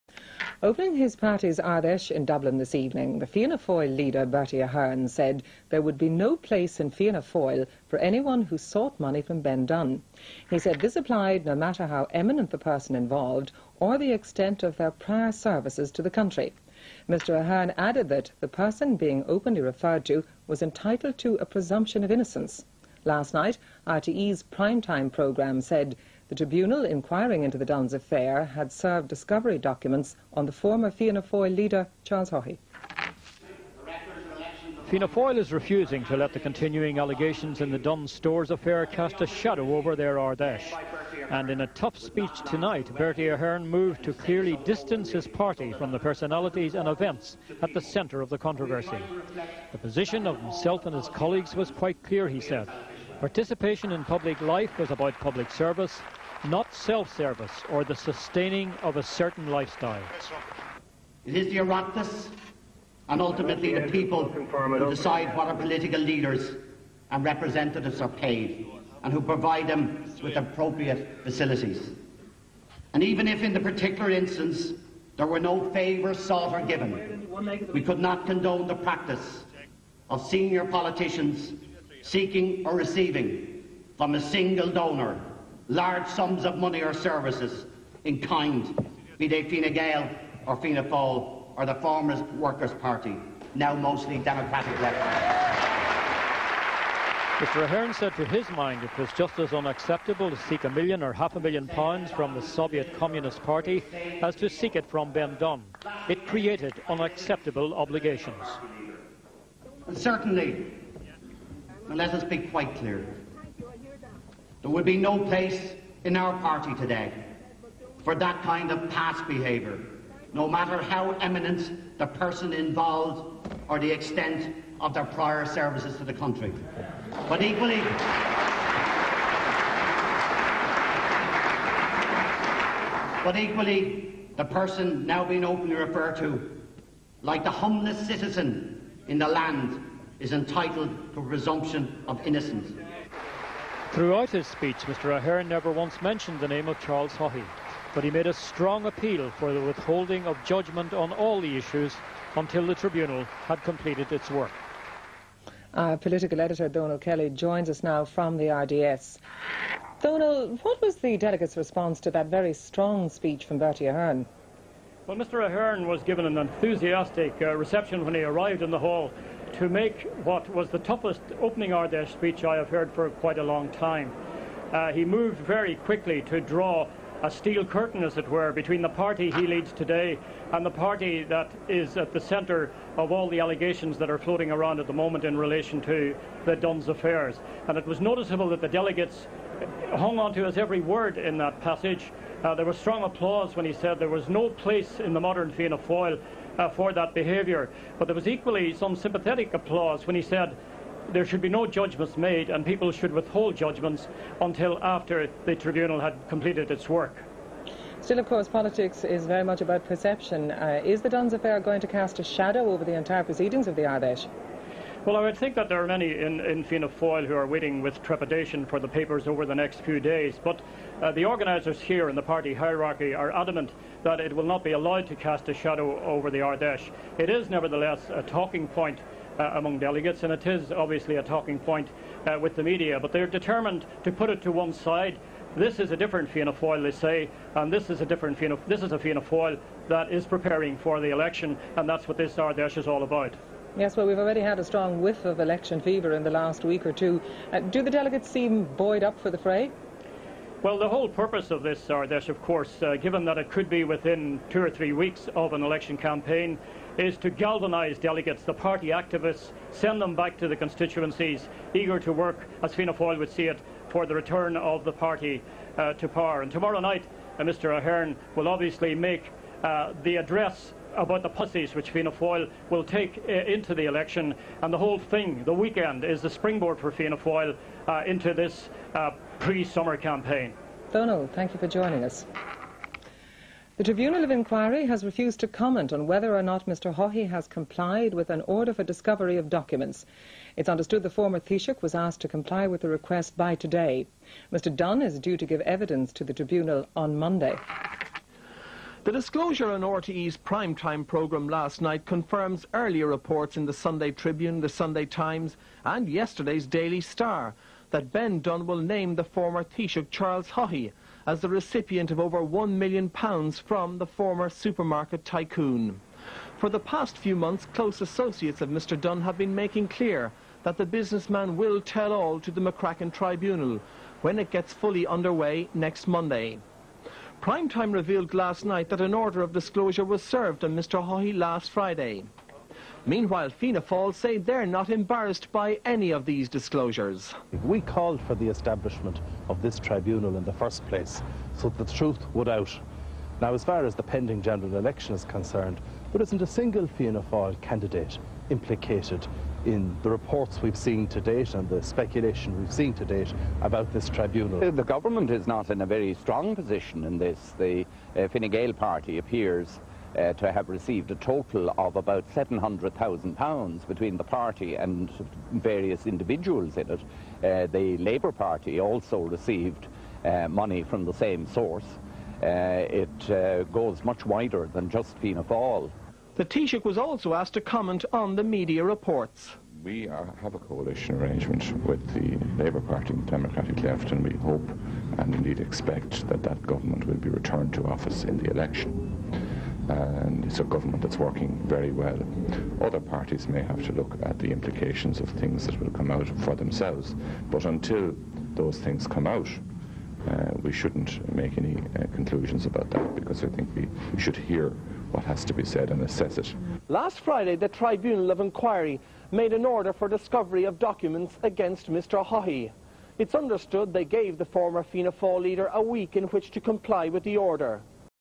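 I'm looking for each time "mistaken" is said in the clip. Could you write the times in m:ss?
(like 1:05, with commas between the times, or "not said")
not said.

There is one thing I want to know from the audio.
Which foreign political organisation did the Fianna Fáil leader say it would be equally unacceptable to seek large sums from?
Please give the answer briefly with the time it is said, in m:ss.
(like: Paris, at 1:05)
Soviet Communist Party, at 1:42.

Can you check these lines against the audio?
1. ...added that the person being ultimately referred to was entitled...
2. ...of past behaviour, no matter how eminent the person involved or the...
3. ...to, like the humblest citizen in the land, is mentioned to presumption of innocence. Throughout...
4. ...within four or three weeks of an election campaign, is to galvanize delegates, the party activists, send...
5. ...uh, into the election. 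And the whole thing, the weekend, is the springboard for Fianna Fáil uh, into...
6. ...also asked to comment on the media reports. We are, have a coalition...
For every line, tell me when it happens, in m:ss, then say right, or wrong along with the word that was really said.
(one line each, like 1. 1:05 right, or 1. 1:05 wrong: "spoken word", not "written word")
1. 0:17 wrong: "openly", not "ultimately"
2. 1:58 right
3. 2:16 wrong: "entitled", not "mentioned"
4. 4:13 wrong: "two", not "four"
5. 4:33 right
6. 6:16 right.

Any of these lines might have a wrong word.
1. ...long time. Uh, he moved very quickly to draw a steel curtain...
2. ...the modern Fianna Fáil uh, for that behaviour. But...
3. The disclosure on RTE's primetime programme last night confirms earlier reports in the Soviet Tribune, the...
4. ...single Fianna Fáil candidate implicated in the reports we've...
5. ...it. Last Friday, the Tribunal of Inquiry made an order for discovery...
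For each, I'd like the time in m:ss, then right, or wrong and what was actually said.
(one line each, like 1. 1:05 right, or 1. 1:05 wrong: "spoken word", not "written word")
1. 2:53 right
2. 3:15 right
3. 4:59 wrong: "Sunday", not "Soviet"
4. 5:46 right
5. 6:46 right.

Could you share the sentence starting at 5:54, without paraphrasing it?
Uh, the government is not in a very strong position in this.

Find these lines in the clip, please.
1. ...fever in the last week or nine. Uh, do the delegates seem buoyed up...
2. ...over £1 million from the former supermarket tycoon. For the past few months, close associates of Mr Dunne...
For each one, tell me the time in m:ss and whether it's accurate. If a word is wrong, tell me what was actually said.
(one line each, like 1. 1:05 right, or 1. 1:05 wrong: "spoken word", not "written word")
1. 4:05 wrong: "two", not "nine"
2. 5:12 right.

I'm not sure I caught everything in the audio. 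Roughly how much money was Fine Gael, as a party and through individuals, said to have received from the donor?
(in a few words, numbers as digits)
£700,000.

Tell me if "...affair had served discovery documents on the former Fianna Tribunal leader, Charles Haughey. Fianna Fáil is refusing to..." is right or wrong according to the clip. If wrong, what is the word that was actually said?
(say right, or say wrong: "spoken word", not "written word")
wrong: "Fáil", not "Tribunal".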